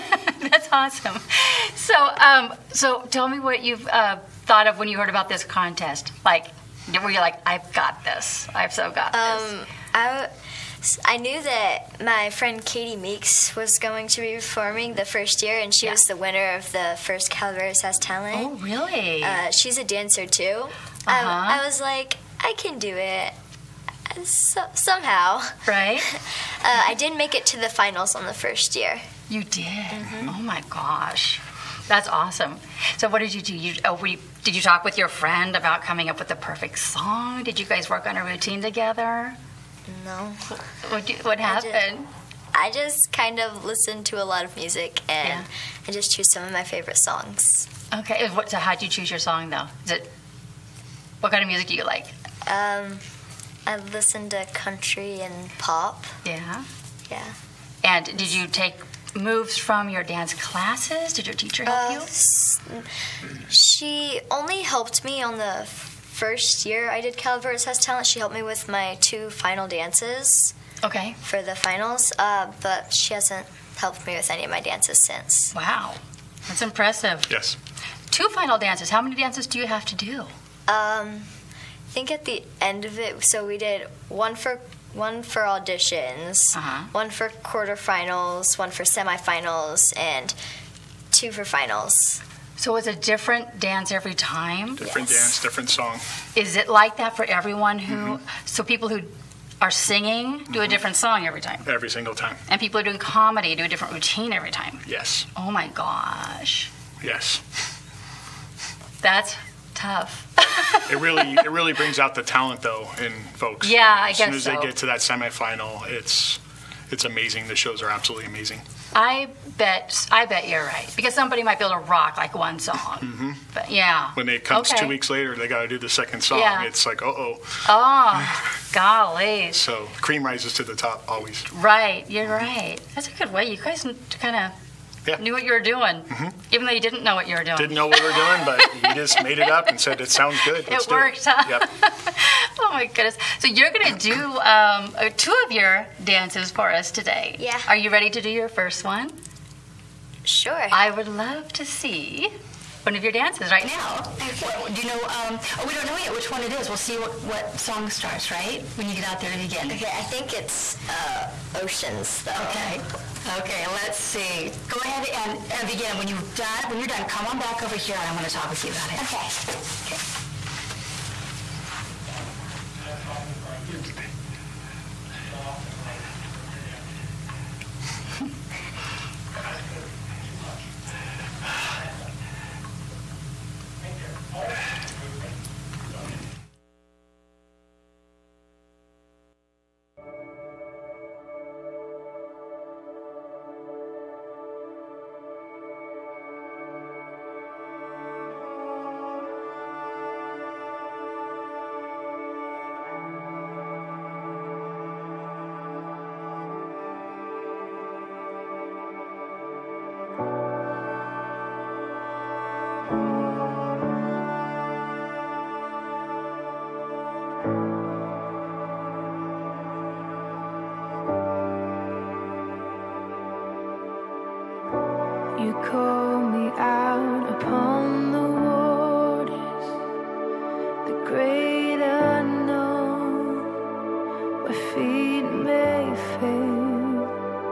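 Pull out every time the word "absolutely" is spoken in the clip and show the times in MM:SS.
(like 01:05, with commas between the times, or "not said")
01:57.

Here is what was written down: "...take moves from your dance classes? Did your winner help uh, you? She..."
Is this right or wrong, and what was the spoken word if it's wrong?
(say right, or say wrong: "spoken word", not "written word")
wrong: "teacher", not "winner".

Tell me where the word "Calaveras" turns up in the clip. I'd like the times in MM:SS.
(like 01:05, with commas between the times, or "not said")
00:17, 01:07.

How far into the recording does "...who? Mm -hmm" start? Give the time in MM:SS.
01:37.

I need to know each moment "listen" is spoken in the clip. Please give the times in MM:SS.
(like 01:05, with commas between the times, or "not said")
00:43, 00:53.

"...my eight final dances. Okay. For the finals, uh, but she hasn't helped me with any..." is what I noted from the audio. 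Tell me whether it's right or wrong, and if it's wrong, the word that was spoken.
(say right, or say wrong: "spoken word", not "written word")
wrong: "two", not "eight".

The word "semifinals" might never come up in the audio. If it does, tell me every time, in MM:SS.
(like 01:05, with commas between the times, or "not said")
01:28, 01:55.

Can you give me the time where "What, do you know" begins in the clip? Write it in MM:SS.
02:34.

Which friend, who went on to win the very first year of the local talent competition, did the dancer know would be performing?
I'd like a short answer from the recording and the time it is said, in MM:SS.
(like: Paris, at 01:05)
Katie Meeks, at 00:12.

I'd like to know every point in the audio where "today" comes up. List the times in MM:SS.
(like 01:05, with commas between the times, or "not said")
02:26.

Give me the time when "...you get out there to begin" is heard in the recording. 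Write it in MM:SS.
02:38.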